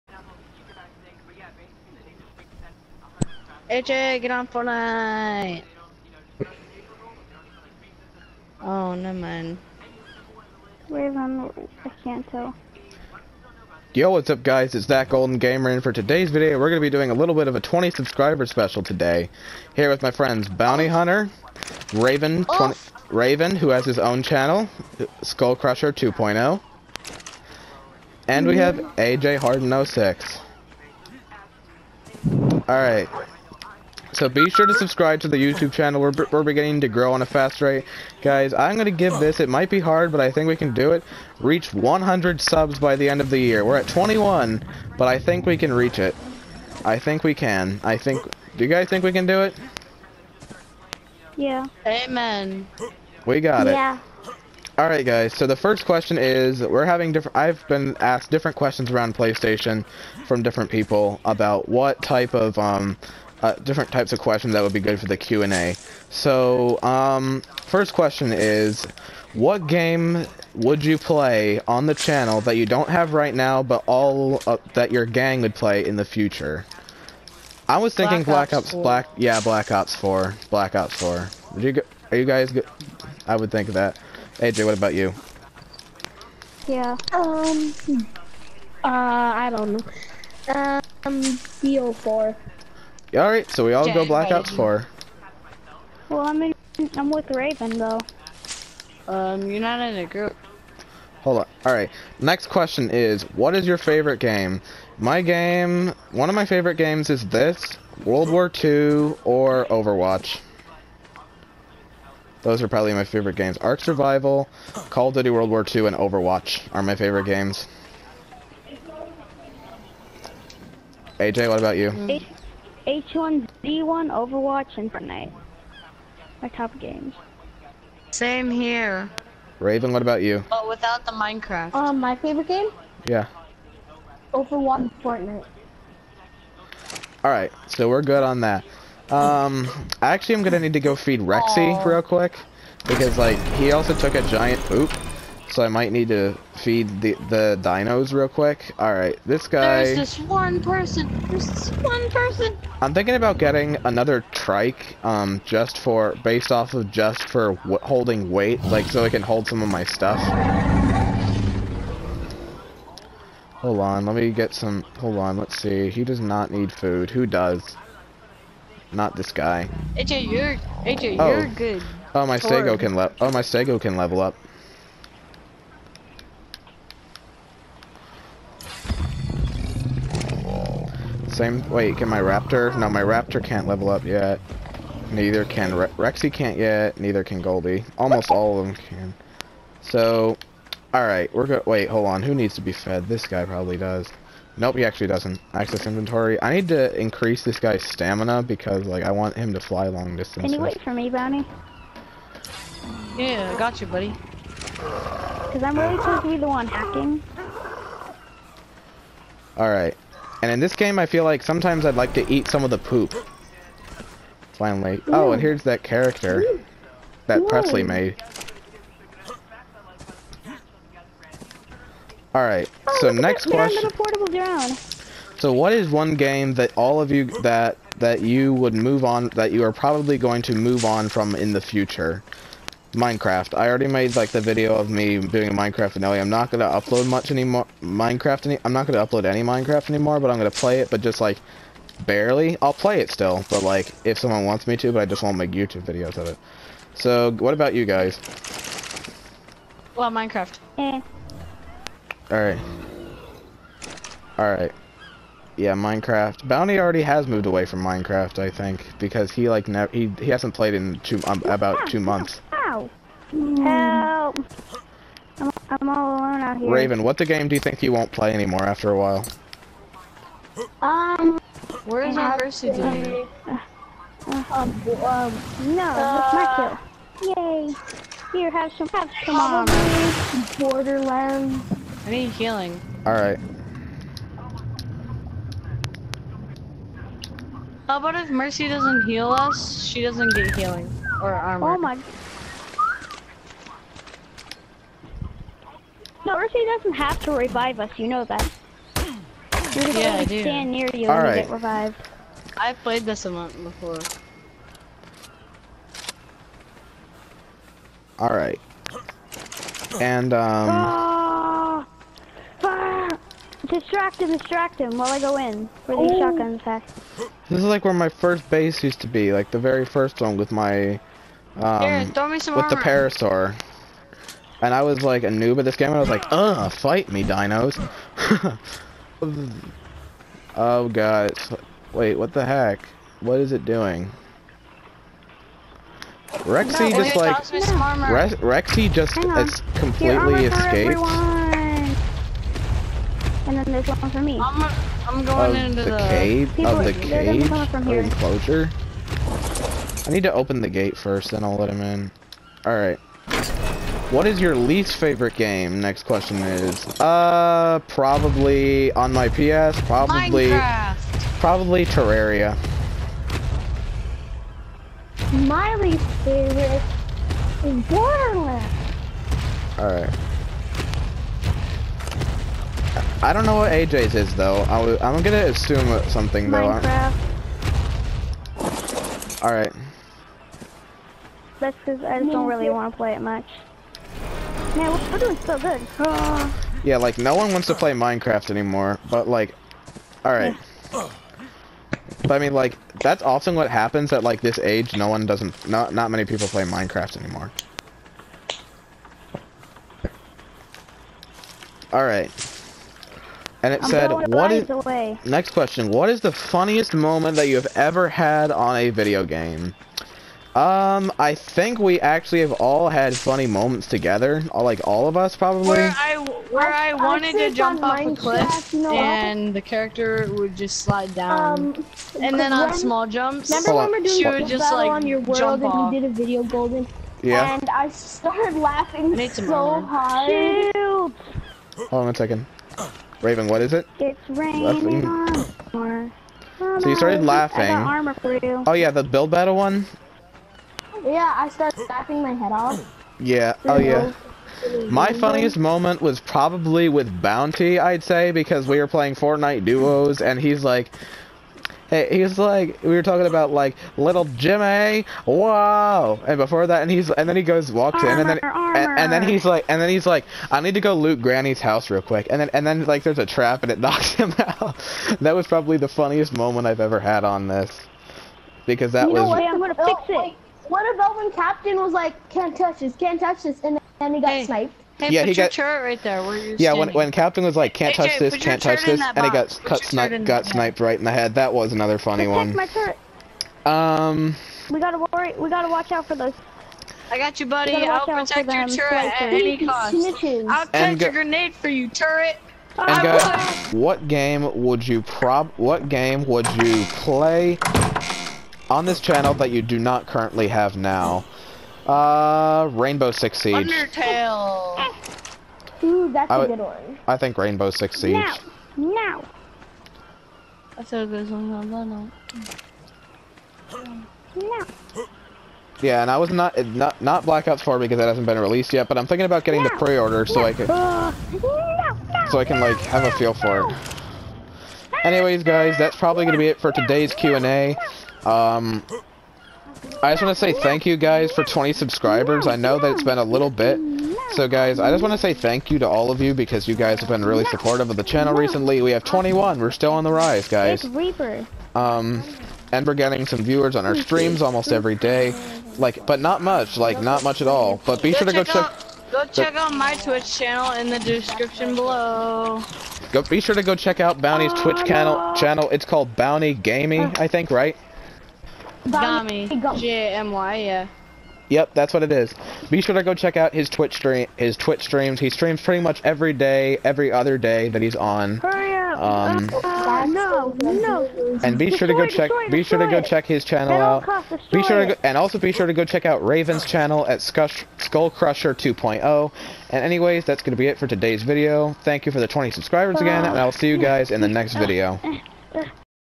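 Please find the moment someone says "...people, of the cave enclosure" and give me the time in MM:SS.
05:46.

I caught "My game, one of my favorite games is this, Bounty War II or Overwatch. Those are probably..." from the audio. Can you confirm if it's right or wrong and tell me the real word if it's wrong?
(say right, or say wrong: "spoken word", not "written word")
wrong: "World", not "Bounty".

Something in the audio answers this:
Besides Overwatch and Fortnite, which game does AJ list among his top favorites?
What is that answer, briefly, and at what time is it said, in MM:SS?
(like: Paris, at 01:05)
H1Z1, at 02:02.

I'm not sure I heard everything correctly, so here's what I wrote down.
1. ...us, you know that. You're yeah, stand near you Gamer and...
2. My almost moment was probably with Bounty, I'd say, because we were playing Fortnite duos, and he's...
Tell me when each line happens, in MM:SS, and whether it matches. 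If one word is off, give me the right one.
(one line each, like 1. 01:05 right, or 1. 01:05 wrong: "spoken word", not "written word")
1. 04:57 wrong: "All", not "Gamer"
2. 07:24 wrong: "funniest", not "almost".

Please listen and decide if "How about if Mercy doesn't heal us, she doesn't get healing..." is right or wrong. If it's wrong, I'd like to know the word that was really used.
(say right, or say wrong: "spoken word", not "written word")
right.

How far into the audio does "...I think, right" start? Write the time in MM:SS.
09:17.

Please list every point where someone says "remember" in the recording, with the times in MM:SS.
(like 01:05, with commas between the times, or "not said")
07:03.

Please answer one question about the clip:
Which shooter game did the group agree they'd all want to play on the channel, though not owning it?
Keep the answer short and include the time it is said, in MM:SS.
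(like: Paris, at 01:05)
Black Ops 4, at 01:20.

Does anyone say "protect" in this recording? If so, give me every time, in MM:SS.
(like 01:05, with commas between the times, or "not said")
08:02, 08:08.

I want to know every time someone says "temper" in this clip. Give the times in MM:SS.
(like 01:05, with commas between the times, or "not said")
not said.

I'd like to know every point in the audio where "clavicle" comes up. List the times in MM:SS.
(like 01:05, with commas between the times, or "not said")
not said.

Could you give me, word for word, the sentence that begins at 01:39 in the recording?
Um, you're not in a group.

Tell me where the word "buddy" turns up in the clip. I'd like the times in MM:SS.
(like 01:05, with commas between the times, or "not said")
03:23, 08:07.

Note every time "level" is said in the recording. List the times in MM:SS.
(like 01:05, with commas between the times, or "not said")
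02:53, 03:03.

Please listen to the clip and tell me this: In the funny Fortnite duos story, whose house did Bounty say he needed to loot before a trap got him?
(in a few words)
Granny's house.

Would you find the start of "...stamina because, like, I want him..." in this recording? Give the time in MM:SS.
03:17.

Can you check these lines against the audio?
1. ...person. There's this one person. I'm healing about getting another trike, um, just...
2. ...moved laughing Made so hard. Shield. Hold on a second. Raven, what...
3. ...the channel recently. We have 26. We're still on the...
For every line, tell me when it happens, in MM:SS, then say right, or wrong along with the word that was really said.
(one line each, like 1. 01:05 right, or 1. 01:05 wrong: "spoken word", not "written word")
1. 02:30 wrong: "thinking", not "healing"
2. 07:07 wrong: "started", not "moved"
3. 08:57 wrong: "21", not "26".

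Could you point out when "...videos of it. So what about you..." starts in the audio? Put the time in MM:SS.
04:05.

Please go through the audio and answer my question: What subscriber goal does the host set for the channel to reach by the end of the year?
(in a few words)
100 subs.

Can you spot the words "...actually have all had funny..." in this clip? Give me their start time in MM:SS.
06:52.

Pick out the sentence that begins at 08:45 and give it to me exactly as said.
Anyways, guys, that's probably going to be it for today's Q&A.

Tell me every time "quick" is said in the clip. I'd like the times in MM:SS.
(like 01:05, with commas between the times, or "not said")
02:22, 02:28, 07:42.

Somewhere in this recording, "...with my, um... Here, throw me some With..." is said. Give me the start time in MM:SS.
05:20.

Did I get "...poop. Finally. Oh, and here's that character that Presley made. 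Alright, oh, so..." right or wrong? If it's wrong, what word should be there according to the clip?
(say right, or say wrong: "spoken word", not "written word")
right.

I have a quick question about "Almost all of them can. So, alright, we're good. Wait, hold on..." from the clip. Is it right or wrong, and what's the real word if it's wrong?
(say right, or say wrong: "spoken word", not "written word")
right.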